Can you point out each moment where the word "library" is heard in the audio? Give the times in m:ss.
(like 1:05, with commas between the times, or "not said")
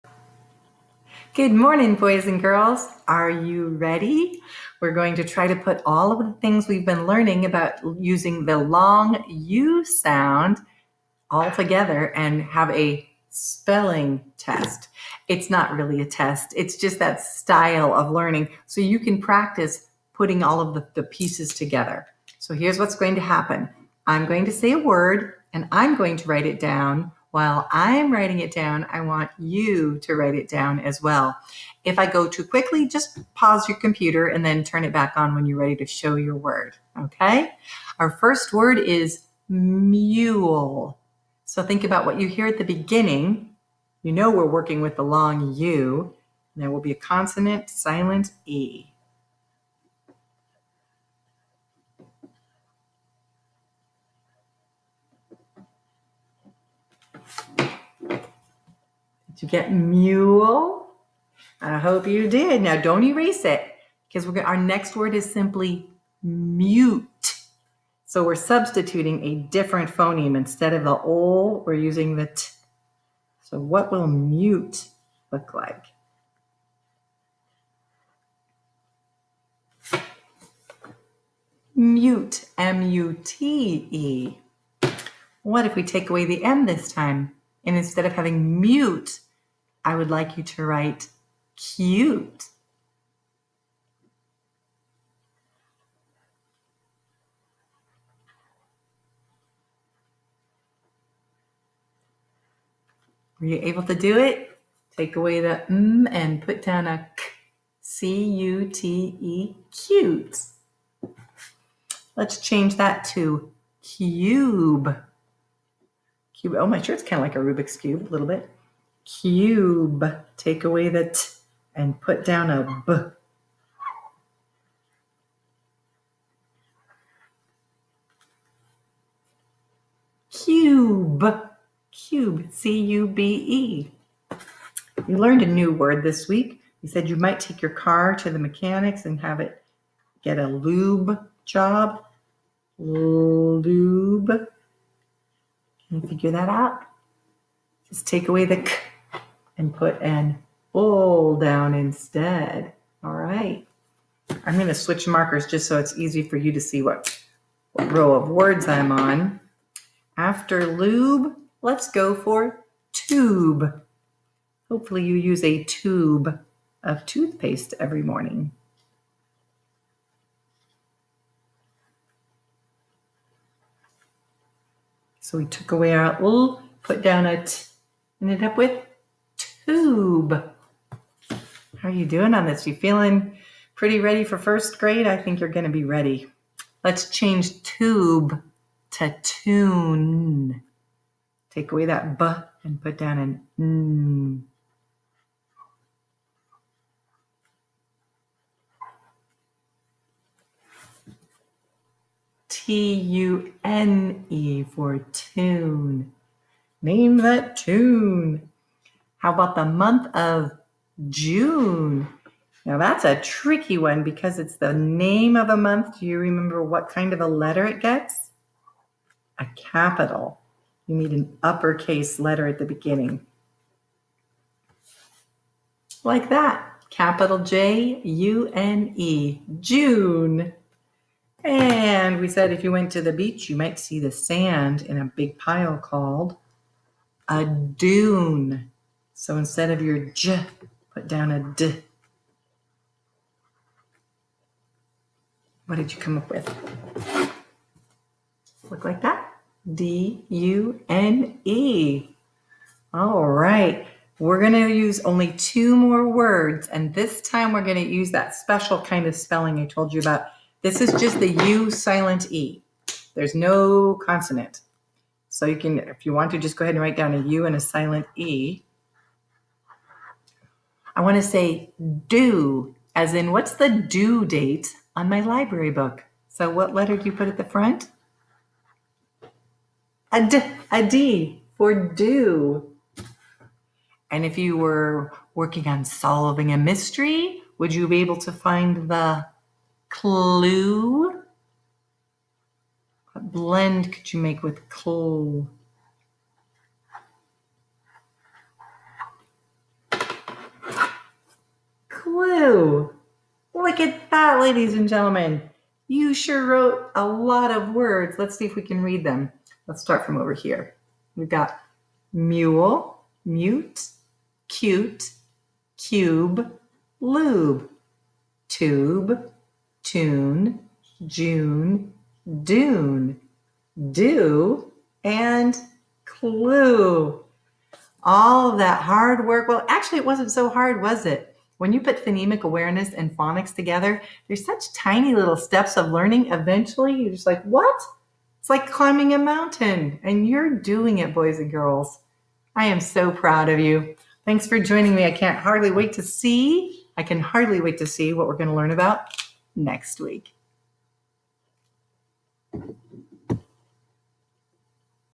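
4:35.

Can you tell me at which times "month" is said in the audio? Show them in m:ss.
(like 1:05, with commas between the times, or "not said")
3:29, 3:35.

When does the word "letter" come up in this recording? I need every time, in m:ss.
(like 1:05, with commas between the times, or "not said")
3:37, 3:42, 4:36.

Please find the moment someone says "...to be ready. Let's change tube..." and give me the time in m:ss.
3:05.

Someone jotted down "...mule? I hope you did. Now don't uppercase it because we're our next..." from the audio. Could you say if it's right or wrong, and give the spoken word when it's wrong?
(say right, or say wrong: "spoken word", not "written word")
wrong: "erase", not "uppercase".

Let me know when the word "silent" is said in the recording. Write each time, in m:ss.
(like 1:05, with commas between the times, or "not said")
0:47, 4:21, 4:27.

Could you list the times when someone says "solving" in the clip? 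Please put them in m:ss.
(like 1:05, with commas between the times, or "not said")
4:45.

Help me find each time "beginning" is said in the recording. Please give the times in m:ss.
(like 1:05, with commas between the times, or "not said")
0:42, 3:42.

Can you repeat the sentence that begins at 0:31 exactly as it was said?
If I go too quickly, just pause your computer and then turn it back on when you're ready to show your word.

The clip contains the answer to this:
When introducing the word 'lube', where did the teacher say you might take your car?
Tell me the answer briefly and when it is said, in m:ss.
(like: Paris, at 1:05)
the mechanics, at 2:18.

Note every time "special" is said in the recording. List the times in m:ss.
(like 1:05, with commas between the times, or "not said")
4:18.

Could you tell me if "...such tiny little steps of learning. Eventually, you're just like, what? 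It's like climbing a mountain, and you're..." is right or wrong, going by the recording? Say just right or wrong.
right.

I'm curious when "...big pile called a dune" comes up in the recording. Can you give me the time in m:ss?
3:55.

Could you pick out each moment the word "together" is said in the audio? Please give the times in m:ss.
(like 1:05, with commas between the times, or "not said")
0:11, 0:21, 5:33.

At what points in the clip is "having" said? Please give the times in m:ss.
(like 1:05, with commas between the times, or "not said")
1:28.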